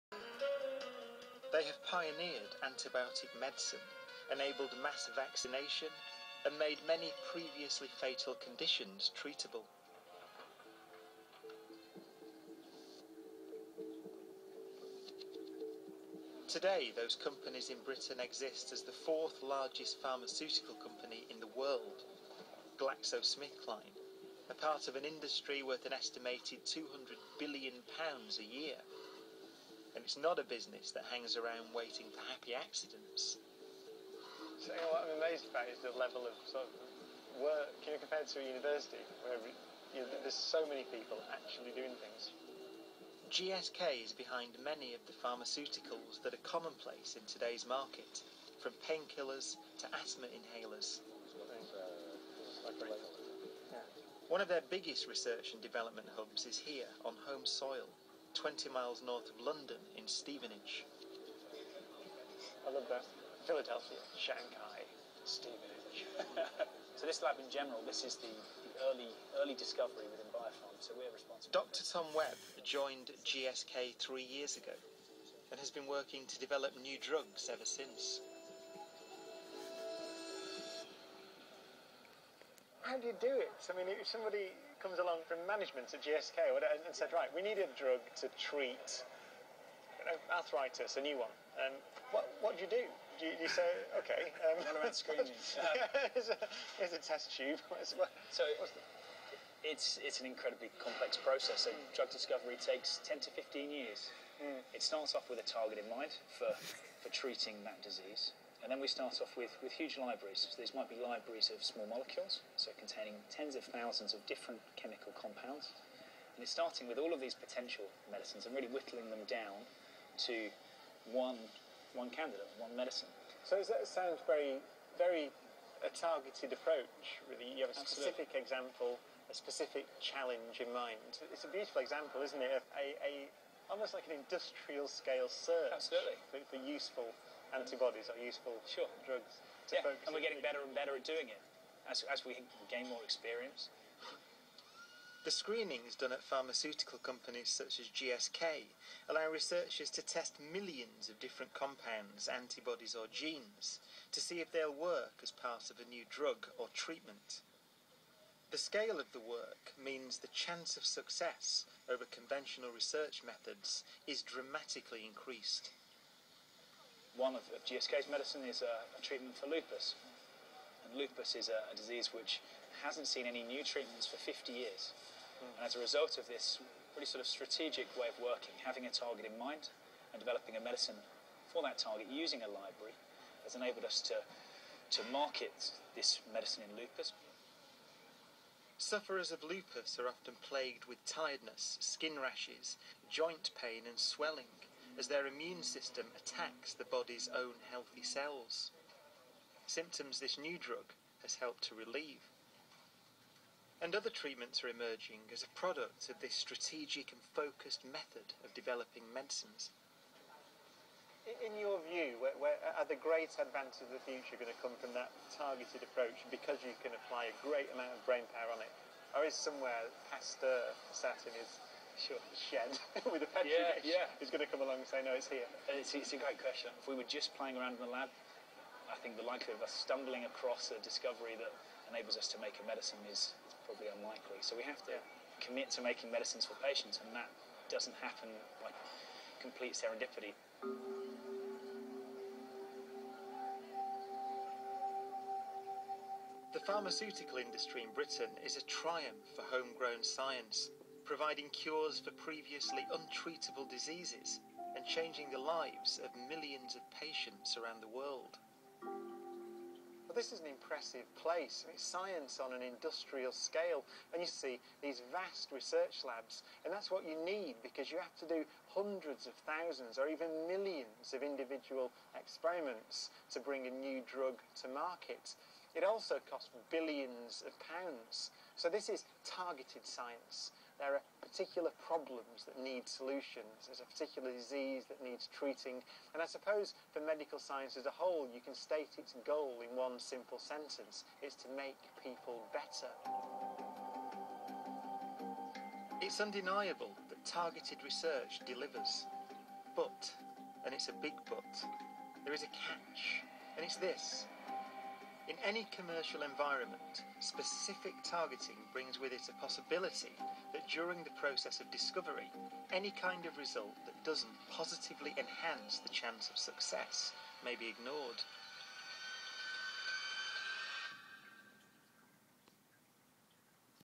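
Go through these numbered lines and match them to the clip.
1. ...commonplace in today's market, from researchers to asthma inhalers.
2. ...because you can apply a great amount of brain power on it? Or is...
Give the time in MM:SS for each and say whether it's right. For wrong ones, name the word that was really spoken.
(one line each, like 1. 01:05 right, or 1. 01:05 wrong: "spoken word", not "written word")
1. 00:46 wrong: "painkillers", not "researchers"
2. 03:36 right.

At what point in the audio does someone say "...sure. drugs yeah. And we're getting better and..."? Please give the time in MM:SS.
02:18.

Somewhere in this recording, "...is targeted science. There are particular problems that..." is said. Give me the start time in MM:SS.
04:38.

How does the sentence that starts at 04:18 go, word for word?
Well, this is an impressive place.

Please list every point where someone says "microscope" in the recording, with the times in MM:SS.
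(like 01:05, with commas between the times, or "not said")
not said.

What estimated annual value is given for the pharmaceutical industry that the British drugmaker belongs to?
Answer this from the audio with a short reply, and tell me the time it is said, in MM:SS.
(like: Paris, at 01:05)
£200 billion, at 00:26.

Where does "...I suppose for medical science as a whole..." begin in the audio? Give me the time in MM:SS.
04:46.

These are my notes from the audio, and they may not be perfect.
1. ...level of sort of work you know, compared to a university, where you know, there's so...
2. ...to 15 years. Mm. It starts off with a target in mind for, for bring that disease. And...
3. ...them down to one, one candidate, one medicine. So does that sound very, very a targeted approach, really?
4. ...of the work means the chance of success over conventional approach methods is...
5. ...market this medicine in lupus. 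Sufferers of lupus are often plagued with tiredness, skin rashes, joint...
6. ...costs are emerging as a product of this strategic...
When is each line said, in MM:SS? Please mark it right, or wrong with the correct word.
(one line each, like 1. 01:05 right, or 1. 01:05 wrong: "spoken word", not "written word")
1. 00:35 right
2. 01:43 wrong: "treating", not "bring"
3. 01:59 right
4. 02:38 wrong: "research", not "approach"
5. 03:05 right
6. 03:24 wrong: "treatments", not "costs".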